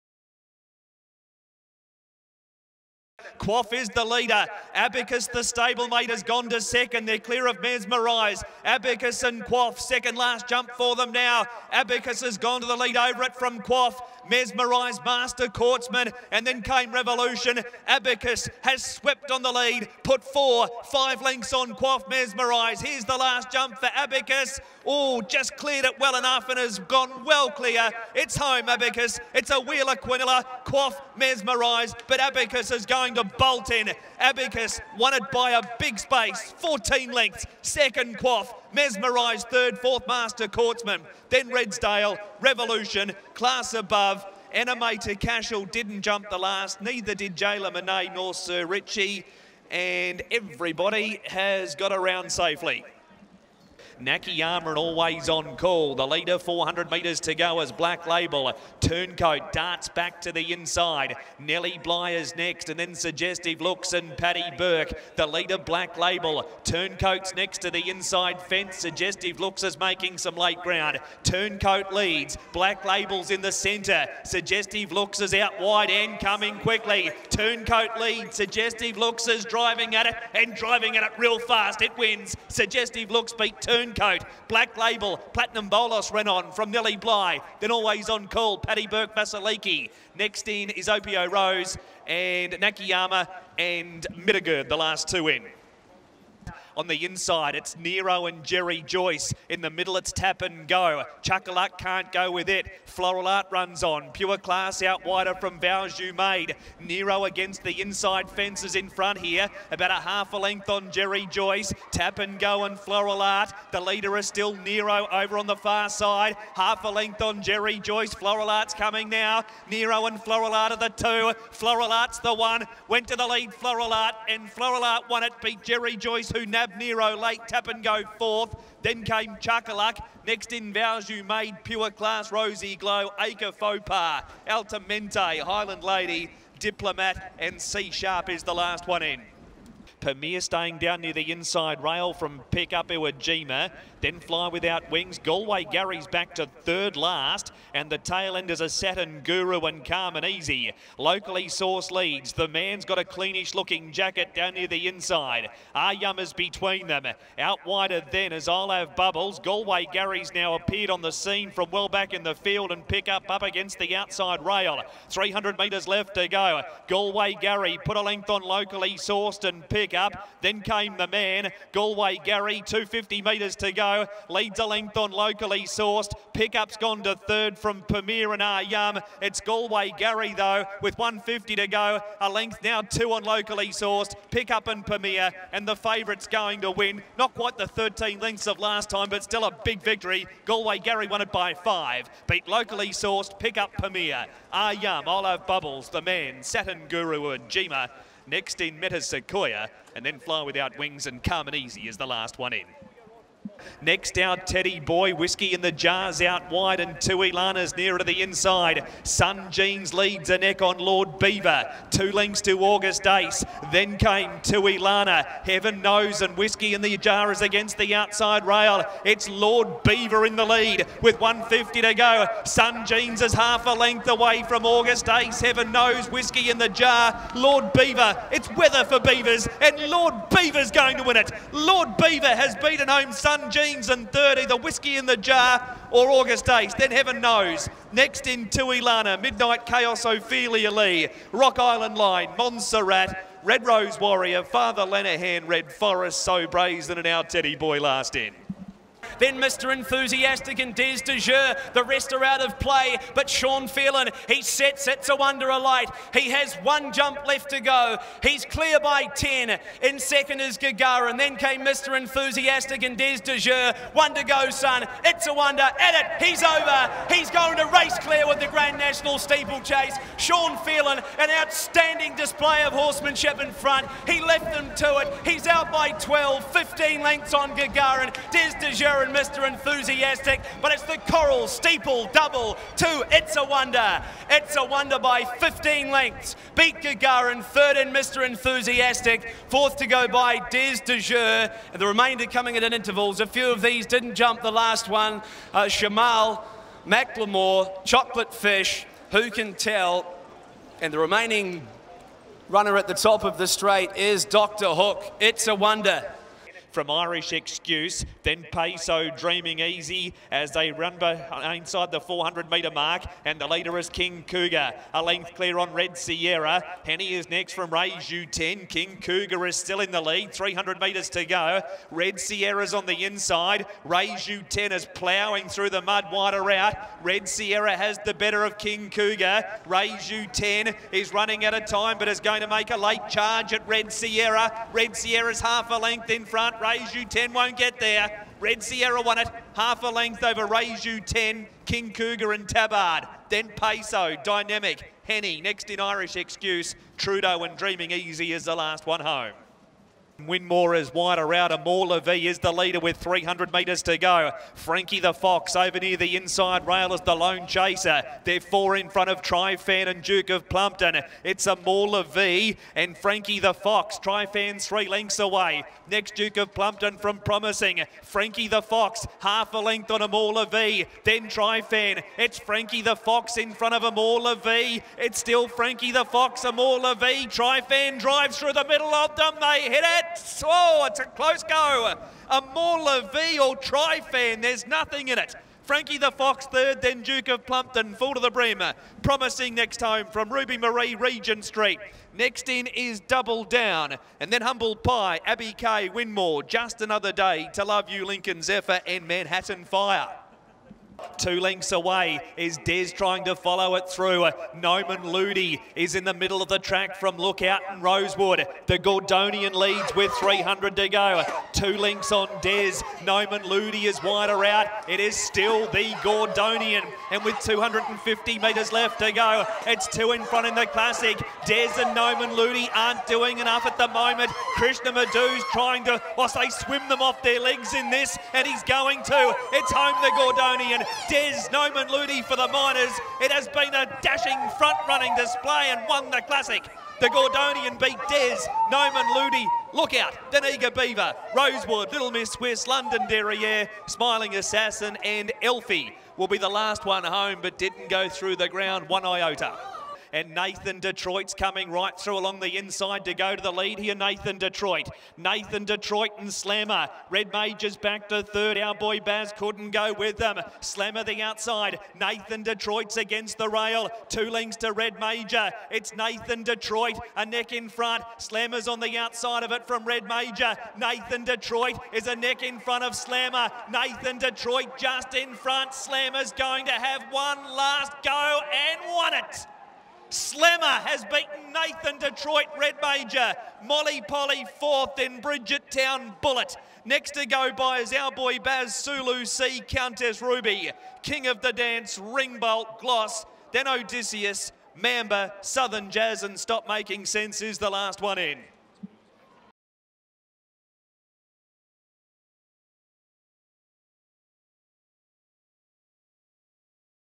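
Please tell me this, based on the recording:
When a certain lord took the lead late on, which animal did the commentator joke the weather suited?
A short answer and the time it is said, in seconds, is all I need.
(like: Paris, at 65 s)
Beavers, at 228 s.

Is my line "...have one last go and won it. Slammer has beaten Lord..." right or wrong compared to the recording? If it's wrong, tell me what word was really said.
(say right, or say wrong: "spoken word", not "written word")
wrong: "Nathan", not "Lord".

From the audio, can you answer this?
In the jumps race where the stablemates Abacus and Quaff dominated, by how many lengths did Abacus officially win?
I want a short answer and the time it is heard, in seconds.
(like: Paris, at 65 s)
14 lengths, at 36 s.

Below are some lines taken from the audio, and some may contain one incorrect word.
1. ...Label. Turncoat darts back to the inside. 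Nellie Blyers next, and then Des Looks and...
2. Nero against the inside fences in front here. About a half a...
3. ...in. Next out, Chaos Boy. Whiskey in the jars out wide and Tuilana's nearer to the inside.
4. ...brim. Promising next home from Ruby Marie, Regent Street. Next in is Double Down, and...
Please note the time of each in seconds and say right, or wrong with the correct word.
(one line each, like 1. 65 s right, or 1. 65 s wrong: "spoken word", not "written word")
1. 58 s wrong: "Suggestive", not "Des"
2. 106 s right
3. 202 s wrong: "Teddy", not "Chaos"
4. 388 s right.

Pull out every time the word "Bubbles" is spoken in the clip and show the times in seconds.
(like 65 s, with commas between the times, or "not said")
158 s, 195 s.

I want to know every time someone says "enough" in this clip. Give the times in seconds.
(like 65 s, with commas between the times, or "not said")
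26 s, 423 s.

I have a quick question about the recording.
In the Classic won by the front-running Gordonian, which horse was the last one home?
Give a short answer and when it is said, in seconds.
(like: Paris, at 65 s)
Elfie, at 445 s.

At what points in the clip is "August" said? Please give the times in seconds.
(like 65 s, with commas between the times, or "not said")
212 s, 224 s, 236 s.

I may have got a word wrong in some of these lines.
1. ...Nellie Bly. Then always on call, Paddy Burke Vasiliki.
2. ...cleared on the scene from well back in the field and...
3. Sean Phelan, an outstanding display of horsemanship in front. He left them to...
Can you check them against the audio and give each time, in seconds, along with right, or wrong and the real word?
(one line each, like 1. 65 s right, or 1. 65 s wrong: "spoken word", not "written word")
1. 86 s right
2. 160 s wrong: "appeared", not "cleared"
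3. 270 s right.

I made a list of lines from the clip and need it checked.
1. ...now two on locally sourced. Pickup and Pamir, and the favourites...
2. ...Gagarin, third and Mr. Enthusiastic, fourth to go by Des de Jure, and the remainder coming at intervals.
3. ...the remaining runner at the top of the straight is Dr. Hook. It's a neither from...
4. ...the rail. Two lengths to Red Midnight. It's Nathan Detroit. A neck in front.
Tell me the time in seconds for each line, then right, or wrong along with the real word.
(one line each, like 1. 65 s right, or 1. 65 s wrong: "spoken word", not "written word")
1. 182 s right
2. 286 s right
3. 300 s wrong: "wonder", not "neither"
4. 463 s wrong: "Major", not "Midnight".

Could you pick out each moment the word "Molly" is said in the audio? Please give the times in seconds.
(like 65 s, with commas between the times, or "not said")
483 s.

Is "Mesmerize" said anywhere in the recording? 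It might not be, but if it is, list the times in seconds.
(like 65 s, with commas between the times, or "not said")
7 s, 14 s, 22 s, 31 s, 38 s.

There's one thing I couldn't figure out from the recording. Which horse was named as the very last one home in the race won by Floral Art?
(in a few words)
C Sharp.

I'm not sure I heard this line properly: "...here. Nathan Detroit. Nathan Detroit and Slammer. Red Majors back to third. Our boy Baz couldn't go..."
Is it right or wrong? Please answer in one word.
right.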